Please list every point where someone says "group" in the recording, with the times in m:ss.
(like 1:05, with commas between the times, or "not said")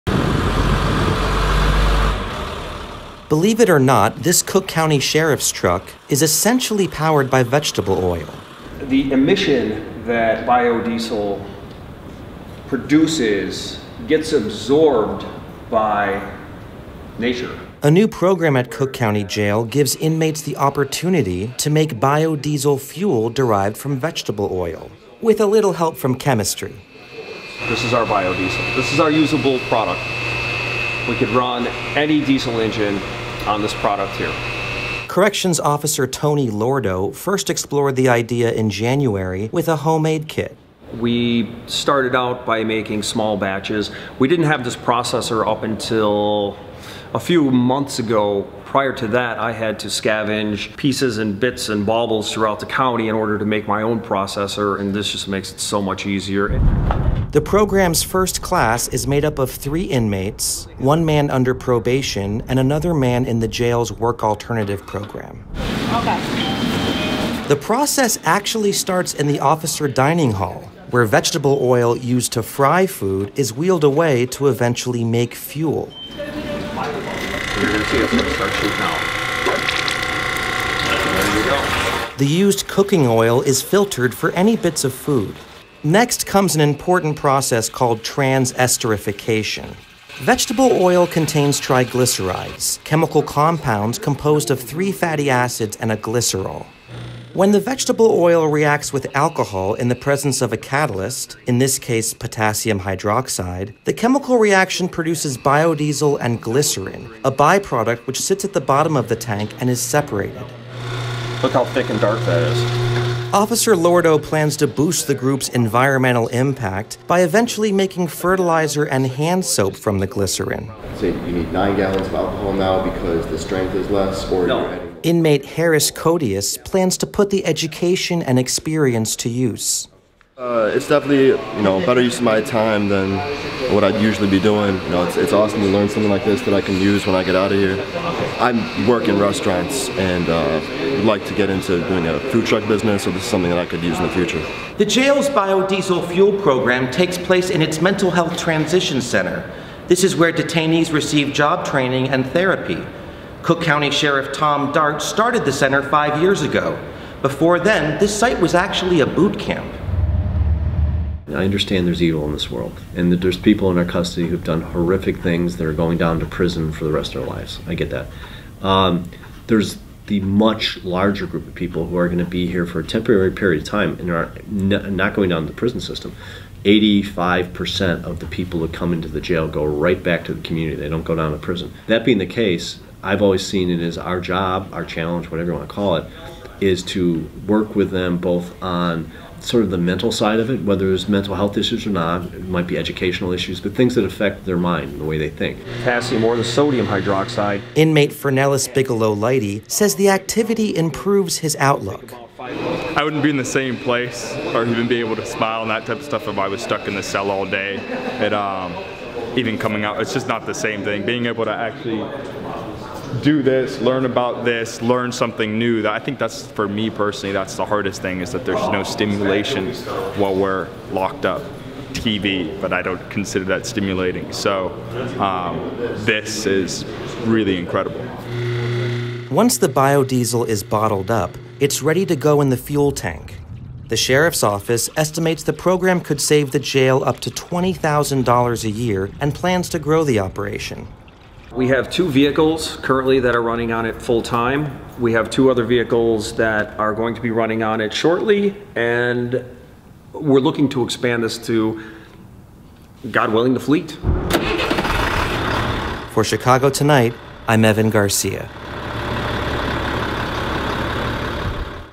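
1:55, 2:51.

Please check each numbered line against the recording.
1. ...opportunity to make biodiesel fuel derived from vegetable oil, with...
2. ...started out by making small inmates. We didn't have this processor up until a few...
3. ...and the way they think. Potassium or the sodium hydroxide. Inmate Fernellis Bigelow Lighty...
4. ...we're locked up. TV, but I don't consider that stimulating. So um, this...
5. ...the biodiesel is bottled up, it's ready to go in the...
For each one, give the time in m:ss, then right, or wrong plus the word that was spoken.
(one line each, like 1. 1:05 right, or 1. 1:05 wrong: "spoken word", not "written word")
1. 0:20 right
2. 0:41 wrong: "batches", not "inmates"
3. 3:14 right
4. 3:40 right
5. 3:49 right.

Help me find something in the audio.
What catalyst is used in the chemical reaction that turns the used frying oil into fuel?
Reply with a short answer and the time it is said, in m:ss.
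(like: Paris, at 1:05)
Potassium hydroxide, at 1:42.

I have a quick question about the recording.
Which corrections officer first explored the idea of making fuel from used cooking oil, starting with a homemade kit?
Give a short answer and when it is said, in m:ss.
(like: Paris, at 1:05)
Tony Lordo, at 0:36.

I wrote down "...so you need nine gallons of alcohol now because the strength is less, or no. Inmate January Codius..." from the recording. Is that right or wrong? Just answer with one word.
wrong.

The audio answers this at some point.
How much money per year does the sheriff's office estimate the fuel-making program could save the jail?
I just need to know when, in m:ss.
3:57.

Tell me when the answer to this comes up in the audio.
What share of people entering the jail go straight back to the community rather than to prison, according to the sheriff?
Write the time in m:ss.
2:56.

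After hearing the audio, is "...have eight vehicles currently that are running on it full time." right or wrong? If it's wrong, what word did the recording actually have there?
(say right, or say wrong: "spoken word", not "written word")
wrong: "two", not "eight".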